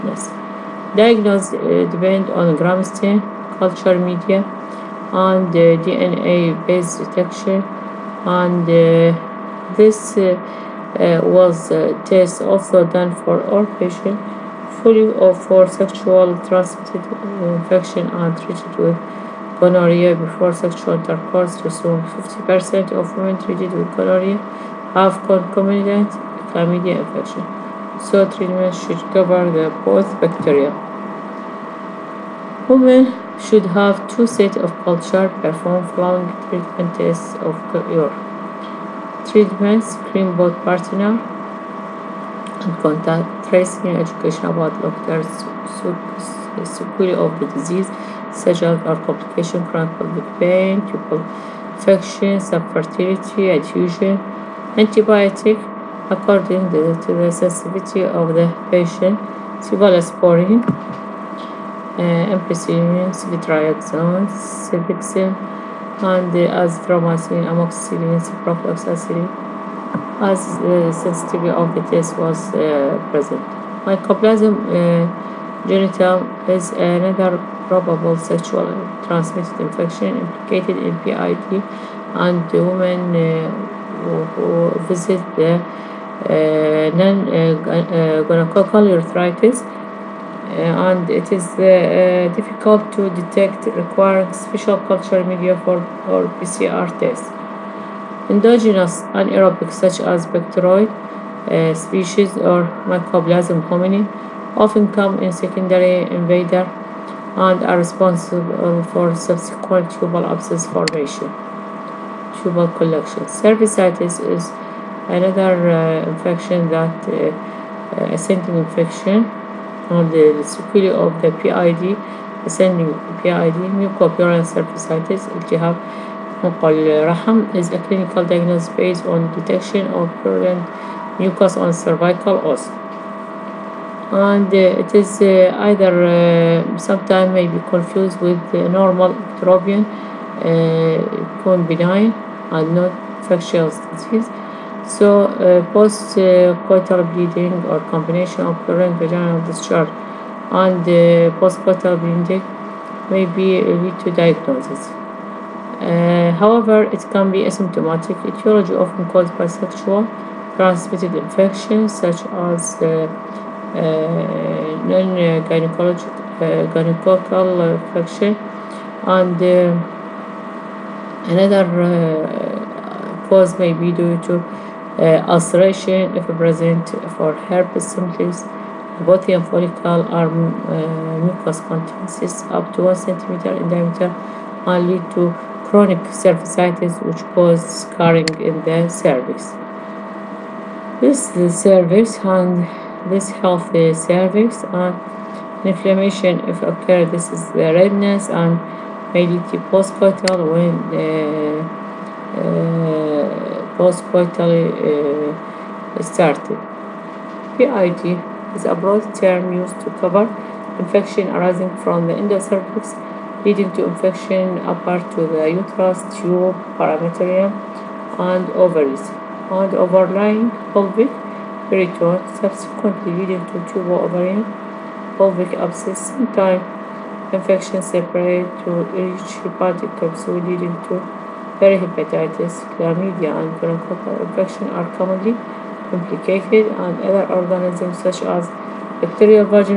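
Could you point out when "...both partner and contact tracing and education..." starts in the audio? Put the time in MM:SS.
00:40.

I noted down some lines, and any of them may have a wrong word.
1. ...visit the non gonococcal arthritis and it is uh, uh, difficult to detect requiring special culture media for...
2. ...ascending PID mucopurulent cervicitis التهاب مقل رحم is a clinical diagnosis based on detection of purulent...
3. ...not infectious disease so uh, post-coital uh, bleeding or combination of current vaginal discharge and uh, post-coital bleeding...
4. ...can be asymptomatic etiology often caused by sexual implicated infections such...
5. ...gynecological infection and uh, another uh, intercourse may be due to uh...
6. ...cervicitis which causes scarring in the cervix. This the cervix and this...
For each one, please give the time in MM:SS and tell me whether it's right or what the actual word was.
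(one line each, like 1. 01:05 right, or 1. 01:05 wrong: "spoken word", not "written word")
1. 01:24 right
2. 02:02 right
3. 02:22 right
4. 02:37 wrong: "transmitted", not "implicated"
5. 02:46 wrong: "cause", not "intercourse"
6. 03:06 right.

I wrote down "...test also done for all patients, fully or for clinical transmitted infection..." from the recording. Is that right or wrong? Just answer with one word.
wrong.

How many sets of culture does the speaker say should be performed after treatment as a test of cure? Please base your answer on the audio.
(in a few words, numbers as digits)
2.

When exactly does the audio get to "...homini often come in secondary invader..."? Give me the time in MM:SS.
01:43.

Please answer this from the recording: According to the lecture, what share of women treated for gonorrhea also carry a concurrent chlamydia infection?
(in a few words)
50%.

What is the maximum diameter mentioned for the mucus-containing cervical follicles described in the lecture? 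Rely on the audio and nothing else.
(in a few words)
1 centimeter.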